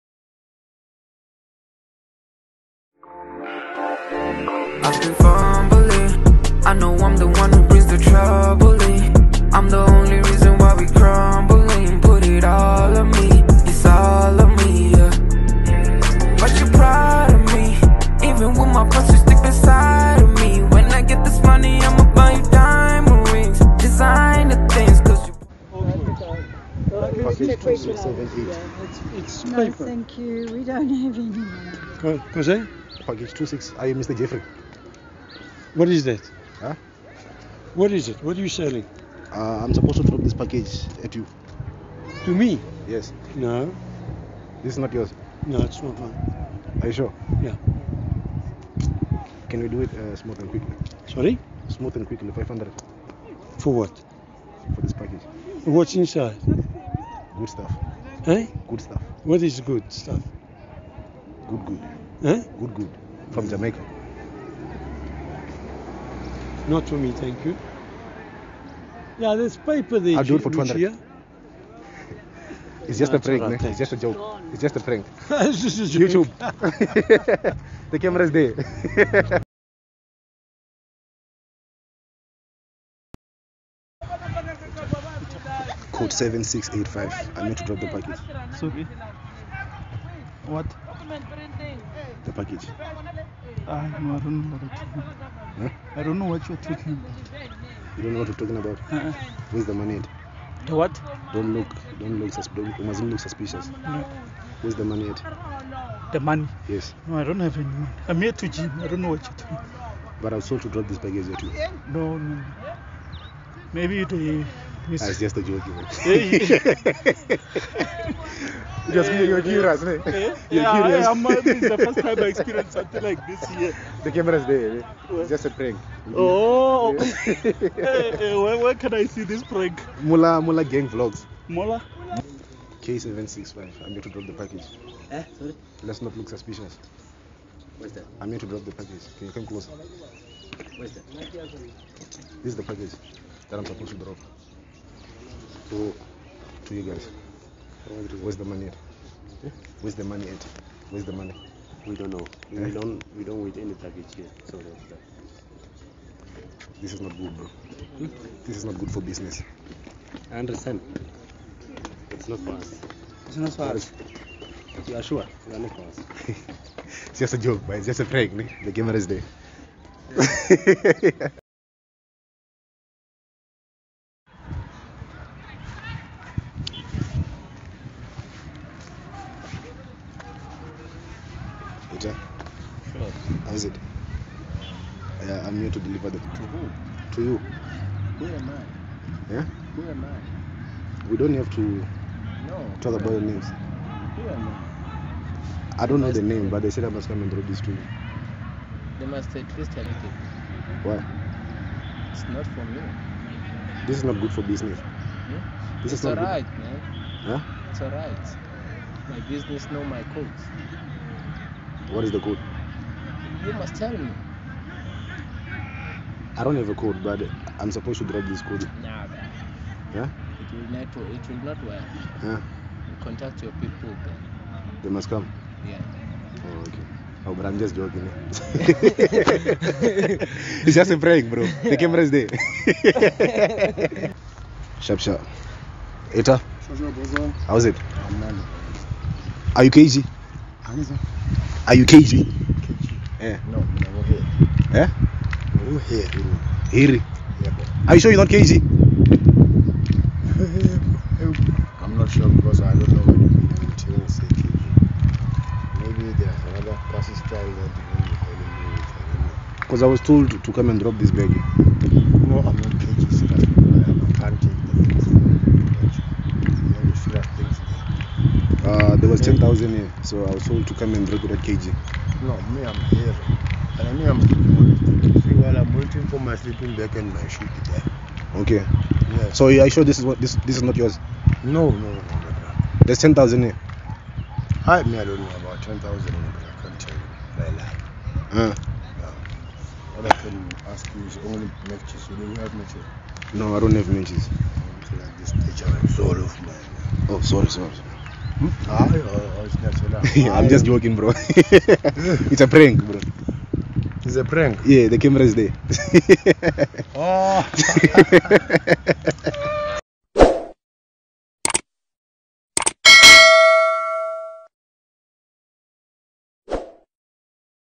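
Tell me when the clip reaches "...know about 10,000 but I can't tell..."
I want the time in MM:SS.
04:45.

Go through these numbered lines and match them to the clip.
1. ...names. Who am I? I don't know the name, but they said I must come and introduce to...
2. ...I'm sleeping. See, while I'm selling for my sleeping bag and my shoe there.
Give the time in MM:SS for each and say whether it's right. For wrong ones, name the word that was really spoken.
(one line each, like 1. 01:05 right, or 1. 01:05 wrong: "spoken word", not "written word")
1. 03:13 right
2. 04:34 wrong: "waiting", not "selling".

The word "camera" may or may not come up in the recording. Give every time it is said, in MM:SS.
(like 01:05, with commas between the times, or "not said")
01:17, 02:04, 02:48, 03:51, 05:04.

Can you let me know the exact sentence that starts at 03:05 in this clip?
Yeah, I'm here to deliver the.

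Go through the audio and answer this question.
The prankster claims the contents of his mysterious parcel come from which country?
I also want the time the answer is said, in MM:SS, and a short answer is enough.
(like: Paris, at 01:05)
Jamaica, at 01:03.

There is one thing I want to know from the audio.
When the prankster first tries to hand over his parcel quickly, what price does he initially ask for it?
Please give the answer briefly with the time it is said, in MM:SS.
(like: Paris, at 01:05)
500, at 00:52.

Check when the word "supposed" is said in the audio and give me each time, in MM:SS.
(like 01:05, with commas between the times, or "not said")
00:39, 02:23, 03:37.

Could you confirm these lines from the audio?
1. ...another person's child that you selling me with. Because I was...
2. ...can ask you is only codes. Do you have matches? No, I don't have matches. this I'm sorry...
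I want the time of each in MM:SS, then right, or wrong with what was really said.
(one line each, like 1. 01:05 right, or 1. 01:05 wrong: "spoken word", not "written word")
1. 04:16 wrong: "calling", not "selling"
2. 04:50 wrong: "matches", not "codes".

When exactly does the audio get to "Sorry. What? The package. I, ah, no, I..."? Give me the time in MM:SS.
01:28.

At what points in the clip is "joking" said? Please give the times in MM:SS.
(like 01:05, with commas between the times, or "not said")
03:47, 05:00.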